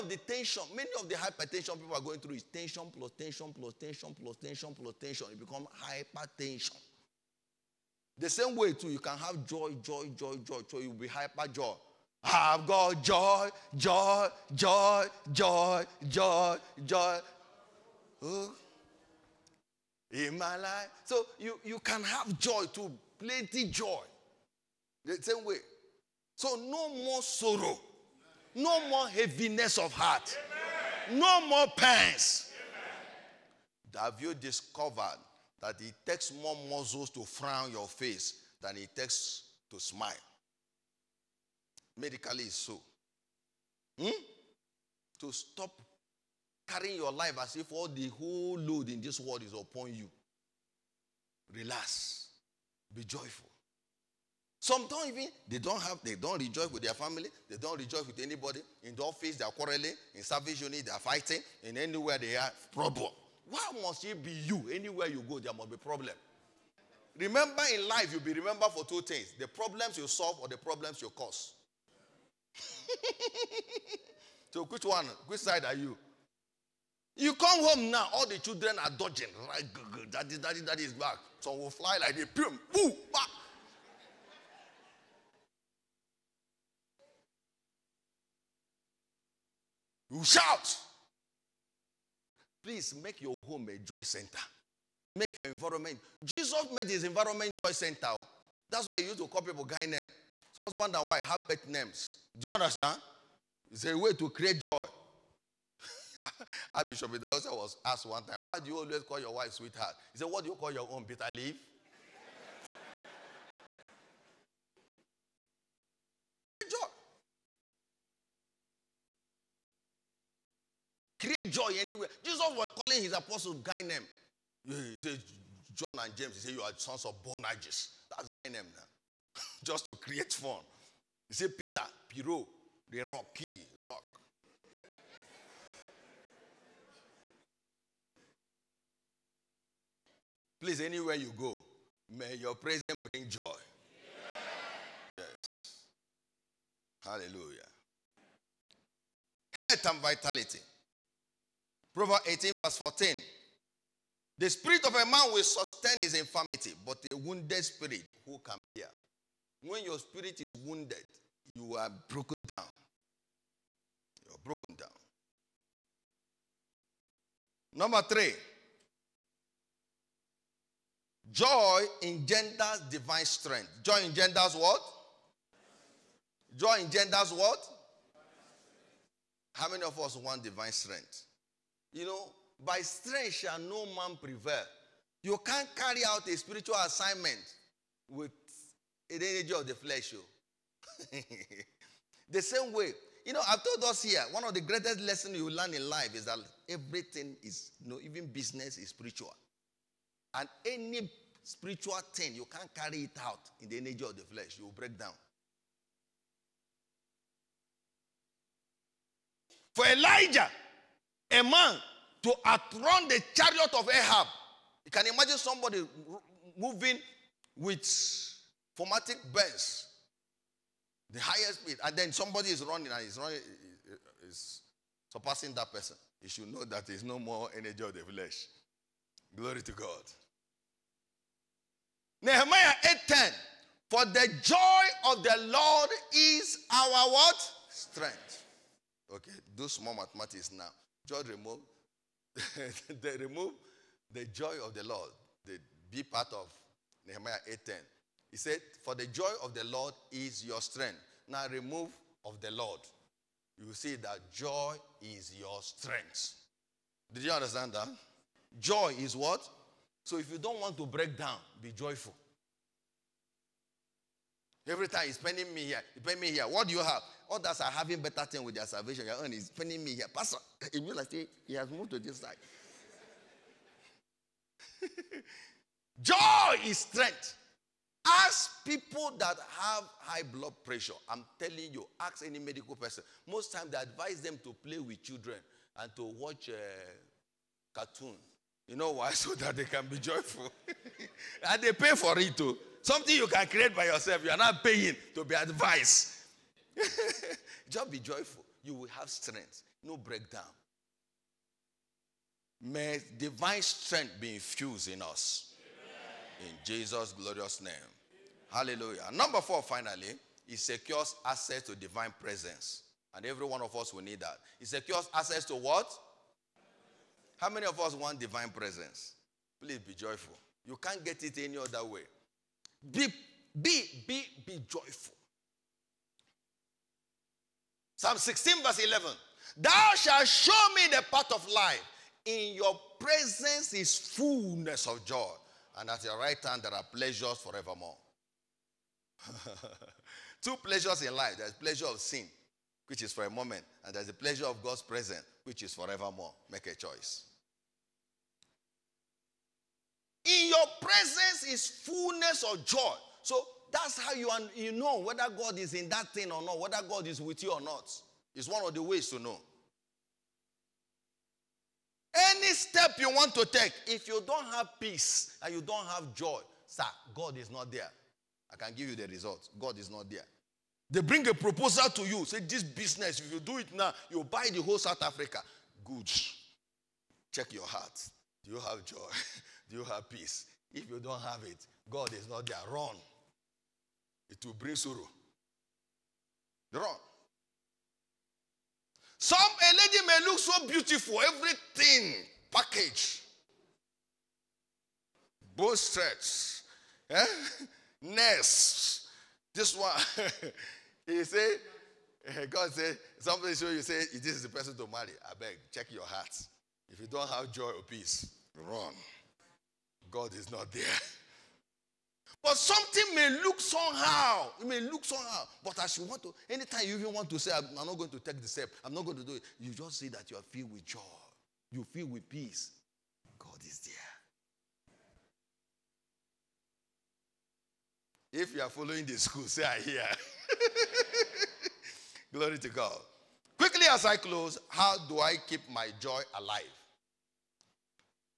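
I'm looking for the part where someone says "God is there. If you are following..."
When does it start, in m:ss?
7:03.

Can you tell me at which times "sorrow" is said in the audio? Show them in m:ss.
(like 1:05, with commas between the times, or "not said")
0:27, 6:24.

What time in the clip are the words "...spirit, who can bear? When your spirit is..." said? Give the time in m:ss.
2:37.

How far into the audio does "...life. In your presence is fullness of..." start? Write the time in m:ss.
5:31.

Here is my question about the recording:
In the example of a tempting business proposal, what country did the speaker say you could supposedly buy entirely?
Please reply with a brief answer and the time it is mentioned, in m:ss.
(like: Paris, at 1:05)
South Africa, at 6:14.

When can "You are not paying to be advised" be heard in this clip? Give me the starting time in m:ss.
4:54.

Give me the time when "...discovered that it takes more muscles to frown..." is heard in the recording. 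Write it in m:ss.
0:34.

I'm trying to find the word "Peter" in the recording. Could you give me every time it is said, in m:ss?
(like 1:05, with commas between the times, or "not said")
2:11.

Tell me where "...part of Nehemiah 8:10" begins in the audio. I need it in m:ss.
4:06.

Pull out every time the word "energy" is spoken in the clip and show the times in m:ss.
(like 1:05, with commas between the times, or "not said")
3:09, 3:23, 3:47.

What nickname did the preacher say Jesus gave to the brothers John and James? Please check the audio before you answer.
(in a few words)
Sons of Boanerges.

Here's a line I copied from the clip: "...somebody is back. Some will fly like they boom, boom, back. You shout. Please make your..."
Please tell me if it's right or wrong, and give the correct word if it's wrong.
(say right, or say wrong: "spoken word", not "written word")
wrong: "daddy", not "somebody".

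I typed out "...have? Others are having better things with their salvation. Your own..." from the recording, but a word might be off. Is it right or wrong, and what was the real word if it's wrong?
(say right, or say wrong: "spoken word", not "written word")
right.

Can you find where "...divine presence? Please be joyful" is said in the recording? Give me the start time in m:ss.
5:18.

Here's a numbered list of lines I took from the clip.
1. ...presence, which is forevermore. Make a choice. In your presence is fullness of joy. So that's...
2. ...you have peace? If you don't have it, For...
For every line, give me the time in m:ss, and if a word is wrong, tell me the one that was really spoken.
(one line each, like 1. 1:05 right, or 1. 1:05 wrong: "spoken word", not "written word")
1. 5:44 right
2. 6:19 wrong: "God", not "For".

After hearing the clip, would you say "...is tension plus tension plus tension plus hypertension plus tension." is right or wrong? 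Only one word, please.
wrong.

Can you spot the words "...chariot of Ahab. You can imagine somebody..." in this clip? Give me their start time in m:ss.
3:33.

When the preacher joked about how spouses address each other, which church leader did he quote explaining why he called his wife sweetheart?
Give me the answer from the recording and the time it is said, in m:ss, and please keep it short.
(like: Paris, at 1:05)
Archbishop Idahosa, at 1:46.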